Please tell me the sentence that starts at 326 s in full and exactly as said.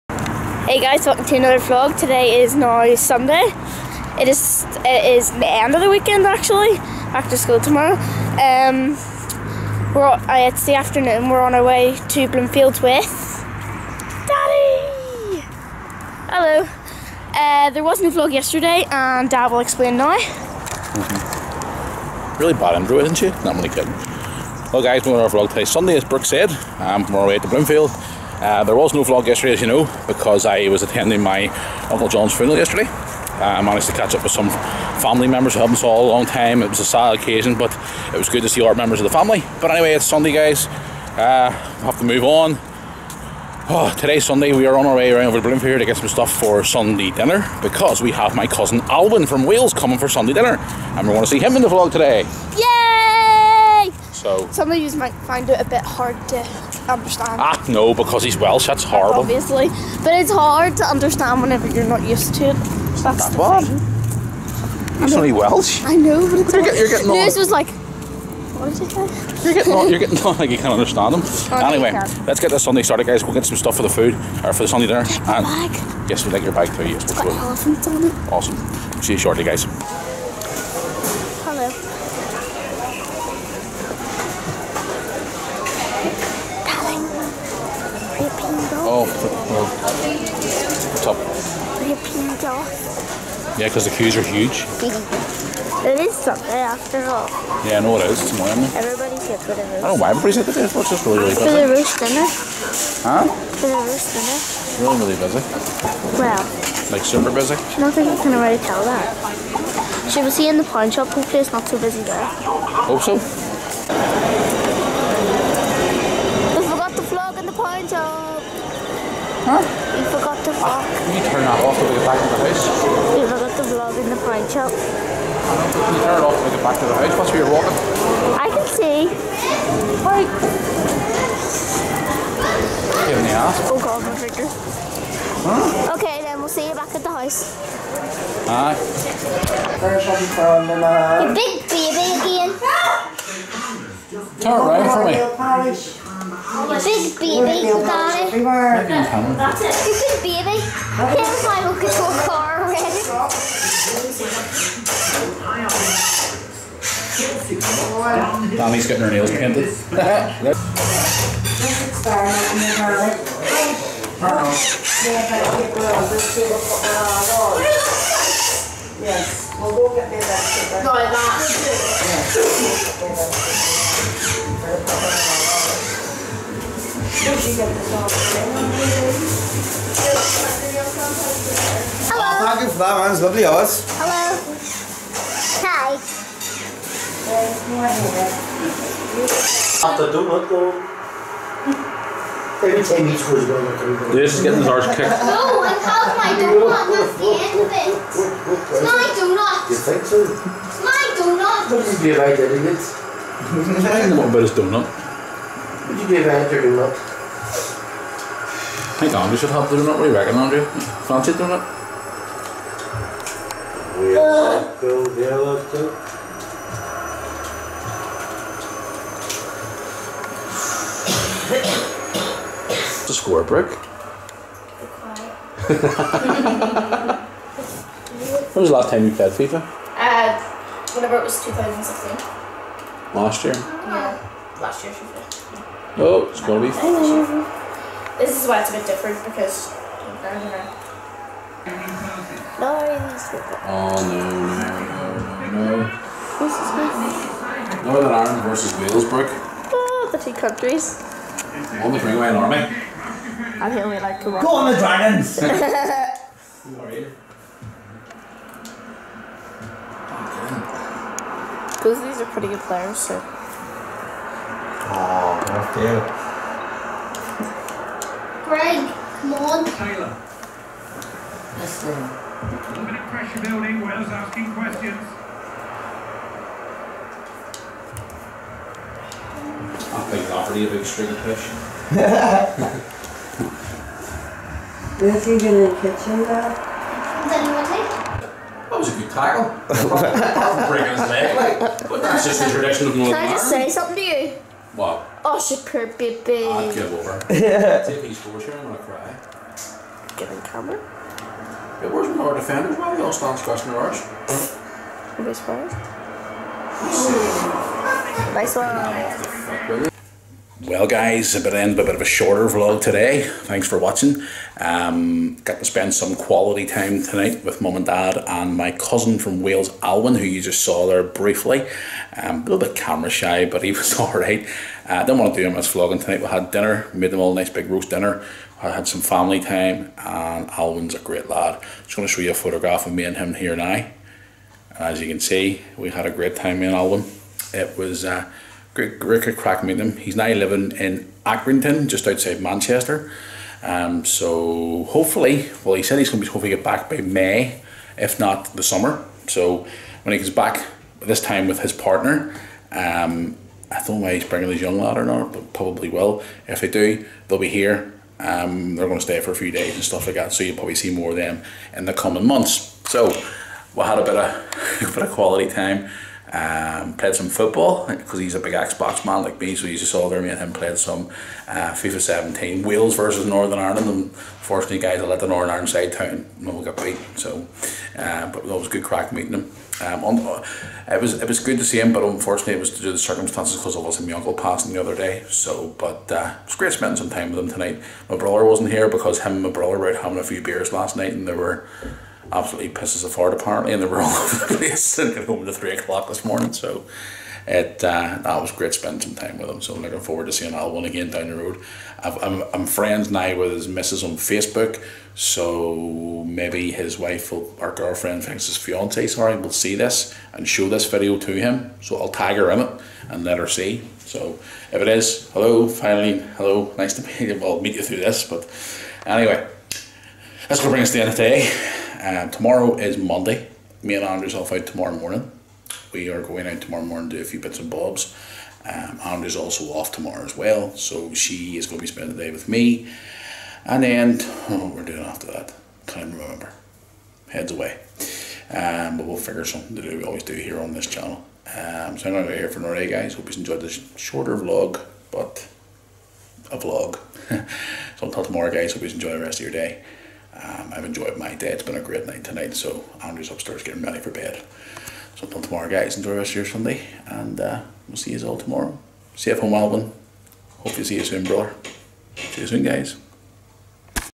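We had dinner, made them all a nice big roast dinner.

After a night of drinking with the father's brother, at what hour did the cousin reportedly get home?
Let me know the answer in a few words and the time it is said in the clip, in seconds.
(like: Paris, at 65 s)
3 o'clock, at 395 s.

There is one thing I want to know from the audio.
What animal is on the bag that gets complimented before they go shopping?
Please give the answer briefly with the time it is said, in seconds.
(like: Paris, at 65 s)
Elephants, at 77 s.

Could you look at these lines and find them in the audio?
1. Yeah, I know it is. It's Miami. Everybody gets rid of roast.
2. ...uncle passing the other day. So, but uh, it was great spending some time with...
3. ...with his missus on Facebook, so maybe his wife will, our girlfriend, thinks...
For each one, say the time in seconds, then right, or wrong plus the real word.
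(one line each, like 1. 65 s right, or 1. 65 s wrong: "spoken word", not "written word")
1. 97 s right
2. 384 s right
3. 403 s right.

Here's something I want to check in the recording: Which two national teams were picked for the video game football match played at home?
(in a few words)
Northern Ireland versus Wales.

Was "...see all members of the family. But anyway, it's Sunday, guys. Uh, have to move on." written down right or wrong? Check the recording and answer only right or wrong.
right.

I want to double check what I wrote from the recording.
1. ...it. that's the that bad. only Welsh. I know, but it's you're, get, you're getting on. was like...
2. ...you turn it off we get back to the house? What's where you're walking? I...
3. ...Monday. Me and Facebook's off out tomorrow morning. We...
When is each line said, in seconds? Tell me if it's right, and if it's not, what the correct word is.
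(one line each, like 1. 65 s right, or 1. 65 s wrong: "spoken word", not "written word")
1. 62 s right
2. 125 s right
3. 422 s wrong: "Andrew", not "Facebook".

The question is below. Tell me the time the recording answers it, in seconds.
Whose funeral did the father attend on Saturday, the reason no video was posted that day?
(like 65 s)
31 s.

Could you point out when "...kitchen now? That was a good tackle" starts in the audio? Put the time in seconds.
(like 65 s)
285 s.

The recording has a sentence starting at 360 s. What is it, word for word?
So you'll probably see more of them in the coming months.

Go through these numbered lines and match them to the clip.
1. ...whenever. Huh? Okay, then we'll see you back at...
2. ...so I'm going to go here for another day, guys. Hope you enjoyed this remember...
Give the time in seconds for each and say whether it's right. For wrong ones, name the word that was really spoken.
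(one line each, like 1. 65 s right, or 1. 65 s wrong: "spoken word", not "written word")
1. 134 s wrong: "finger", not "whenever"
2. 441 s wrong: "shorter", not "remember".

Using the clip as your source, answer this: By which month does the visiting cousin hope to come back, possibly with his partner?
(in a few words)
May.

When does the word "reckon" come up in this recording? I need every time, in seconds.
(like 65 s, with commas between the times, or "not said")
210 s.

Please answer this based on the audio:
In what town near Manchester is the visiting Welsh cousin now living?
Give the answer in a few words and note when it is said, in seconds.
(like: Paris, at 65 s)
Accrington, at 341 s.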